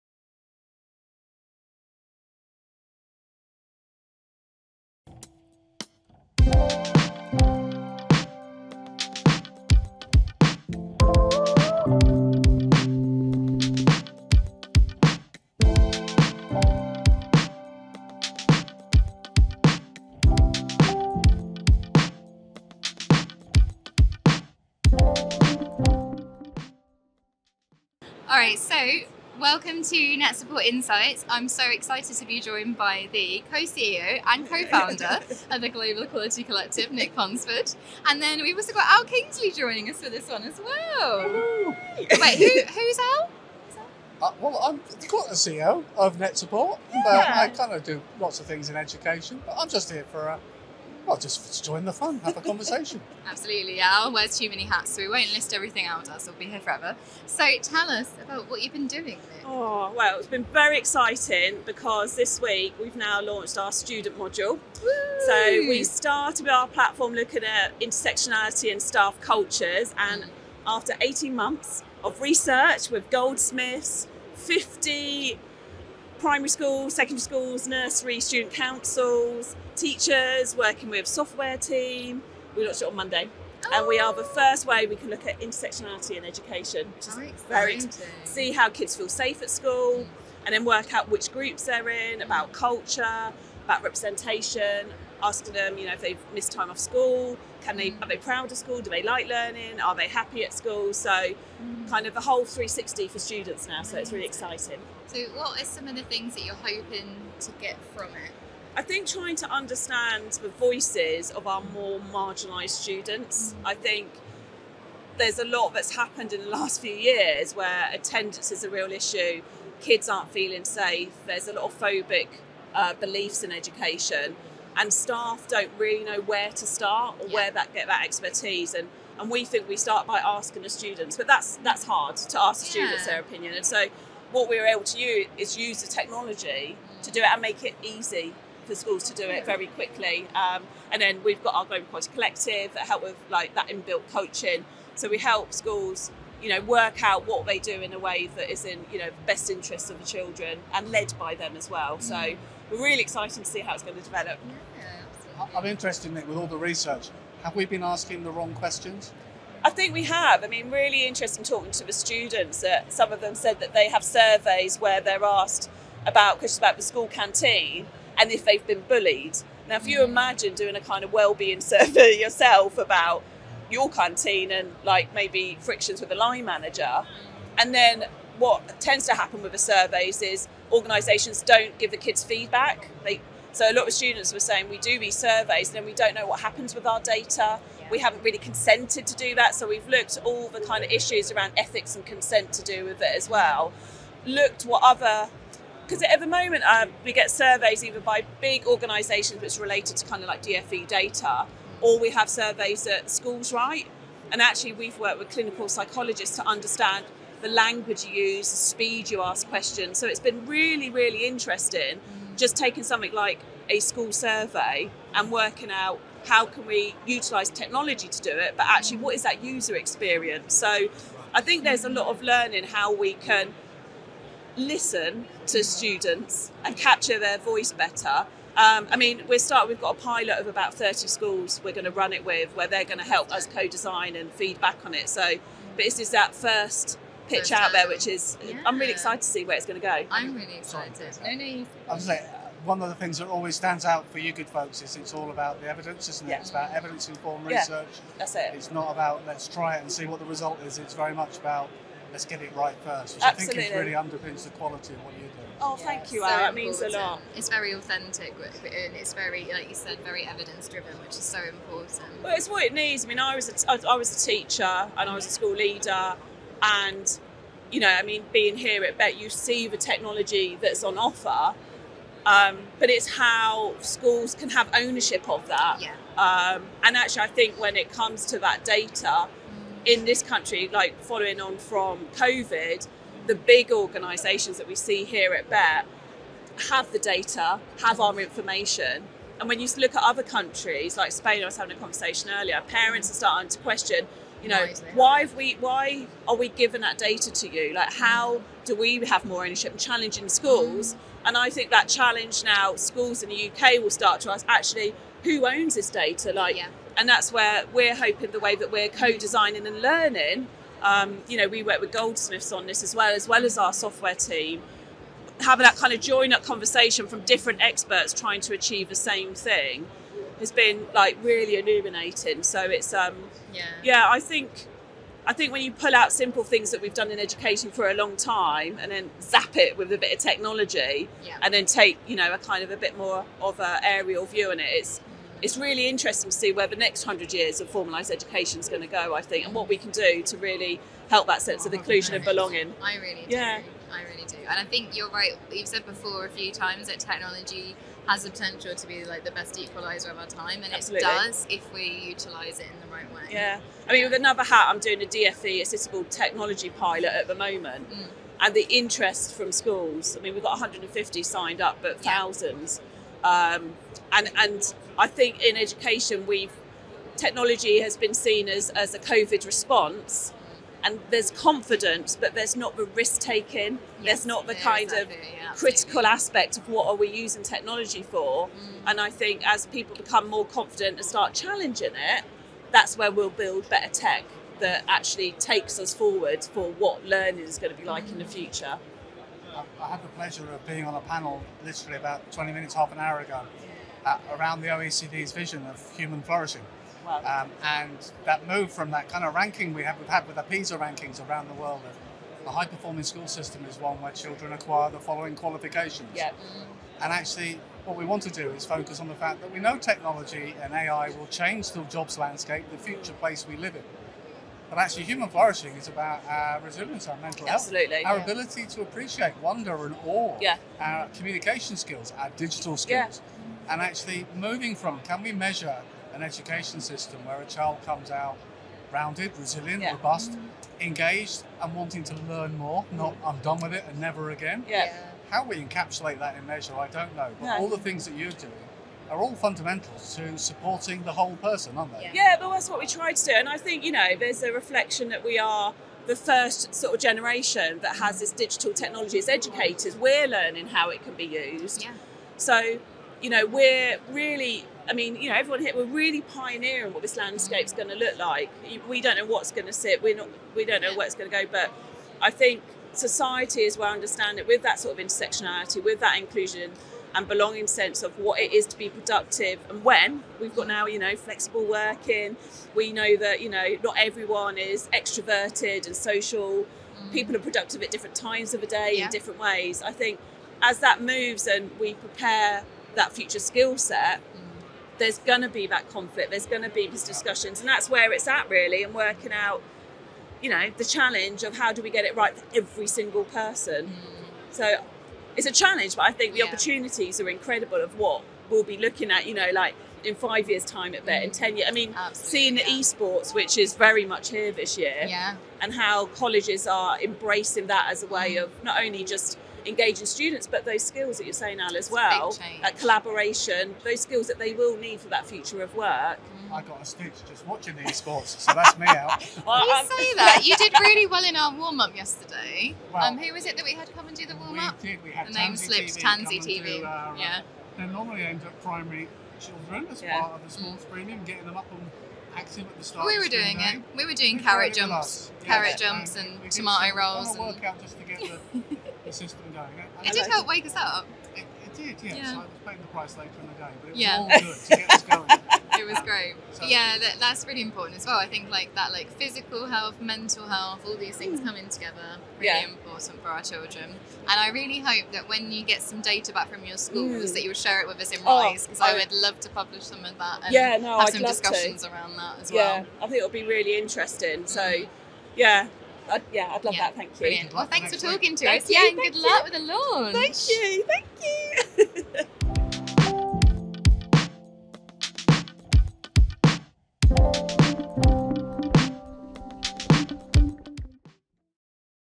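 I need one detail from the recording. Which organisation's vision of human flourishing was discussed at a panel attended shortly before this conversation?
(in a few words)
OECD.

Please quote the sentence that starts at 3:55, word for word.
So, but this is that first pitch That's out there, which is yeah.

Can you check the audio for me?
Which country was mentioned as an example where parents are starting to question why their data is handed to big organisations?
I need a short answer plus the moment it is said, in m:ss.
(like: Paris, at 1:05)
Spain, at 4:51.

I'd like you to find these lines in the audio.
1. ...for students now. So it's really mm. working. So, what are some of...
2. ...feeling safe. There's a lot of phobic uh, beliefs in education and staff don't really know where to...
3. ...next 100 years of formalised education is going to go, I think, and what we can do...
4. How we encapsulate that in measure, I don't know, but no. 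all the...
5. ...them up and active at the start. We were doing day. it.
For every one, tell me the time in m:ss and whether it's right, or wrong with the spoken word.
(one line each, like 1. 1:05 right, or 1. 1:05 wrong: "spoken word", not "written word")
1. 1:43 wrong: "exciting", not "working"
2. 2:00 right
3. 5:36 right
4. 7:15 right
5. 8:51 right.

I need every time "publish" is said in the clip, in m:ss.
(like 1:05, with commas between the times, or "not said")
9:19.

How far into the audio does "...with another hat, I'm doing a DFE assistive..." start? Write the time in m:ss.
5:54.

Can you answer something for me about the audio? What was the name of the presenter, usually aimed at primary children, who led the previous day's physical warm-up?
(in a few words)
Tansy TV.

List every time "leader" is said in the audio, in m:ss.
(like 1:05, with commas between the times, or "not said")
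4:25.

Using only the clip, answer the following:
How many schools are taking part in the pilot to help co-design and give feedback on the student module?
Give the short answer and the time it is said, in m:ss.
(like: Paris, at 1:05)
30, at 3:50.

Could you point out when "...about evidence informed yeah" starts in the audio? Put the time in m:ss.
4:06.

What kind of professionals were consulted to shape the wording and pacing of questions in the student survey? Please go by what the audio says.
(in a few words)
Clinical psychologists.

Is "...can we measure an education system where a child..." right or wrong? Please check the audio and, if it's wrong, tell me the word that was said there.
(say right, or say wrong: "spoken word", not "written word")
right.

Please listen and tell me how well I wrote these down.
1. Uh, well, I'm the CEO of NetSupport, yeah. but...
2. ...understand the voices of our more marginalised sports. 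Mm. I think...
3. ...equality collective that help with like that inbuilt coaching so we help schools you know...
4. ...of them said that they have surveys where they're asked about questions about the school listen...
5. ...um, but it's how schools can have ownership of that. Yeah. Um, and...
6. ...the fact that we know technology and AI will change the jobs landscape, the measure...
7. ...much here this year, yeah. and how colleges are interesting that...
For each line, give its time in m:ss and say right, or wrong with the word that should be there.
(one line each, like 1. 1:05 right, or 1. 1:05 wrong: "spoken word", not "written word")
1. 0:44 right
2. 1:49 wrong: "students", not "sports"
3. 2:21 right
4. 2:43 wrong: "canteen", not "listen"
5. 4:32 right
6. 6:49 wrong: "future", not "measure"
7. 8:24 wrong: "embracing", not "interesting".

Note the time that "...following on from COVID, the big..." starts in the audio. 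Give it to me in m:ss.
4:41.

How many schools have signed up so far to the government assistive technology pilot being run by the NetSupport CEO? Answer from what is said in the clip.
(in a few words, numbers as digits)
150.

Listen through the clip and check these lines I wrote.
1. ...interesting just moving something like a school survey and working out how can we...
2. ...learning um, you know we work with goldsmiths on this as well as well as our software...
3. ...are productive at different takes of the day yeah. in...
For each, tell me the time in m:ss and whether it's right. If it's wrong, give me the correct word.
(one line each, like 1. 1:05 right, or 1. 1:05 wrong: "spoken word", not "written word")
1. 3:31 wrong: "taking", not "moving"
2. 5:09 right
3. 7:57 wrong: "times", not "takes".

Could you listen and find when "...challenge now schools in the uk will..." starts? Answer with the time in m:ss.
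5:01.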